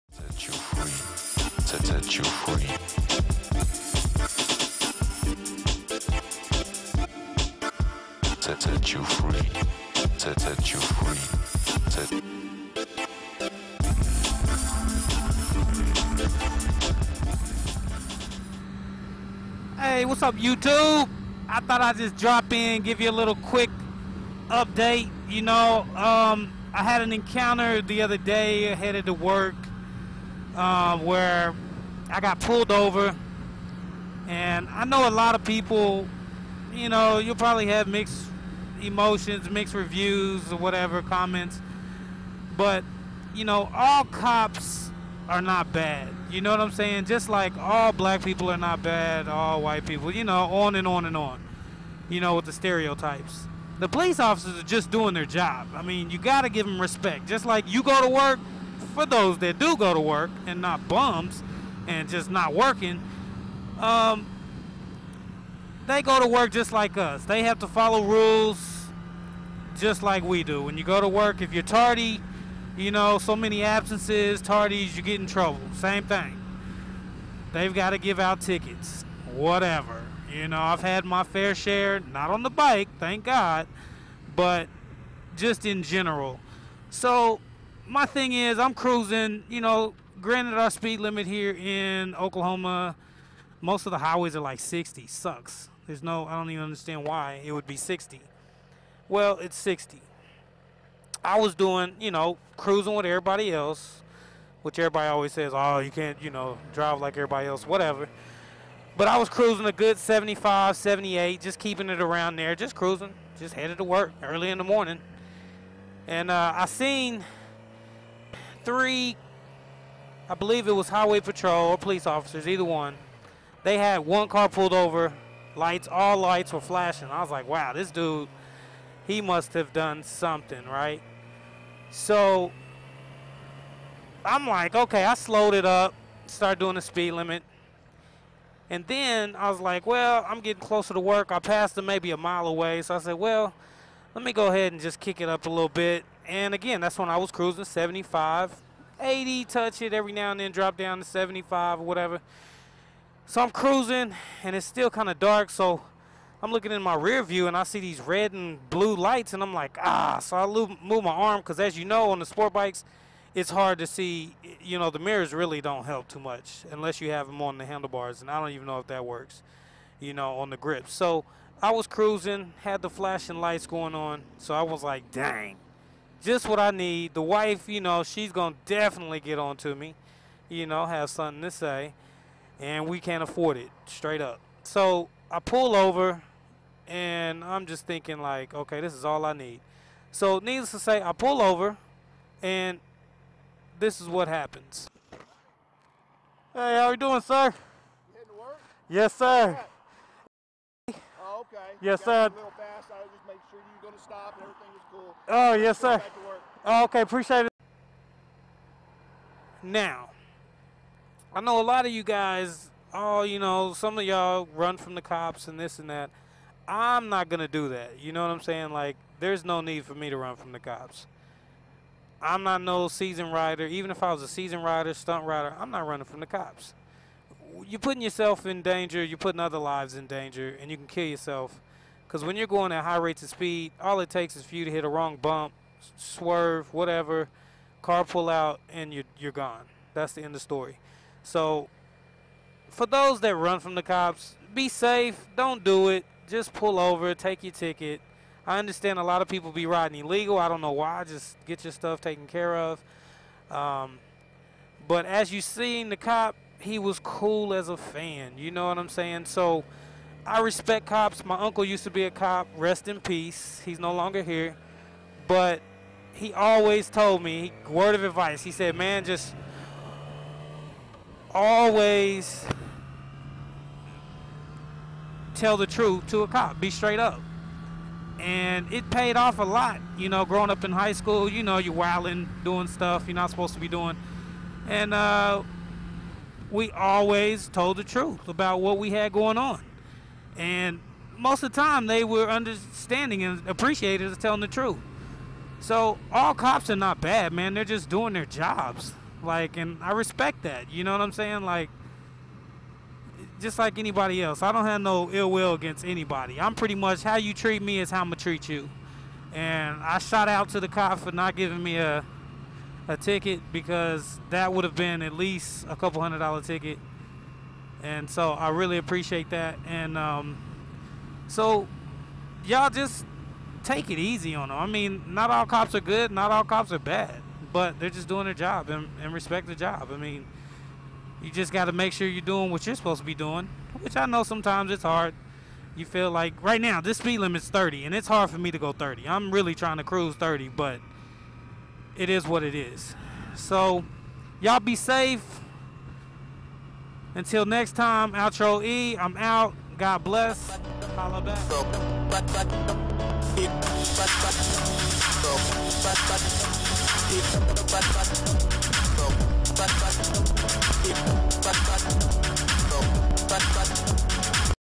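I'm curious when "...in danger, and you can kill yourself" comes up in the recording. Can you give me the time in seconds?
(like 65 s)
229 s.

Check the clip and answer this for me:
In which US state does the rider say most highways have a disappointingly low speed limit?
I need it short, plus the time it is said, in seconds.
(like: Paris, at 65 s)
Oklahoma, at 92 s.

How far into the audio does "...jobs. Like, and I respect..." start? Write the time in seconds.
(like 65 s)
298 s.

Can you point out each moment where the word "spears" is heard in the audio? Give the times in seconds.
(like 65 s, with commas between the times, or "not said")
not said.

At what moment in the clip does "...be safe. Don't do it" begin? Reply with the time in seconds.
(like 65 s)
244 s.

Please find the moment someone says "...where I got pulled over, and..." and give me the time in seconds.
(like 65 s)
30 s.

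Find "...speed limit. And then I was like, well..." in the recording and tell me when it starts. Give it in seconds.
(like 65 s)
136 s.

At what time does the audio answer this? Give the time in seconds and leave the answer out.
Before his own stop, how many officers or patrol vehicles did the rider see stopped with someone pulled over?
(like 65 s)
118 s.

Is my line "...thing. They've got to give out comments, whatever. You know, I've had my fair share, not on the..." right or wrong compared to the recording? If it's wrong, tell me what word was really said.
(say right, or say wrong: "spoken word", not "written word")
wrong: "tickets", not "comments".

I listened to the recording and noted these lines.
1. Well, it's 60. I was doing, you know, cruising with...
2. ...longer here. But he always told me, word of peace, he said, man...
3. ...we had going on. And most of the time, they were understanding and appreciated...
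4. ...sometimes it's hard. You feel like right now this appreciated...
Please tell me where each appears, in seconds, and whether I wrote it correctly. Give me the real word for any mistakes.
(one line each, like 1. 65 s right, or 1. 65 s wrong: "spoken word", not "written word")
1. 99 s right
2. 263 s wrong: "advice", not "peace"
3. 288 s right
4. 334 s wrong: "speed", not "appreciated".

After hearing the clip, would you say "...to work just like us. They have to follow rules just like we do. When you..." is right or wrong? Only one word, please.
right.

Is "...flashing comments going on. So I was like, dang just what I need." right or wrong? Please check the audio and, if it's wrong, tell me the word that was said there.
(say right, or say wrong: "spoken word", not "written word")
wrong: "lights", not "comments".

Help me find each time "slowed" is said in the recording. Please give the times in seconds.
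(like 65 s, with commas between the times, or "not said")
135 s.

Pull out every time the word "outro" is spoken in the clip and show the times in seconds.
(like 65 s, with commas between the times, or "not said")
348 s.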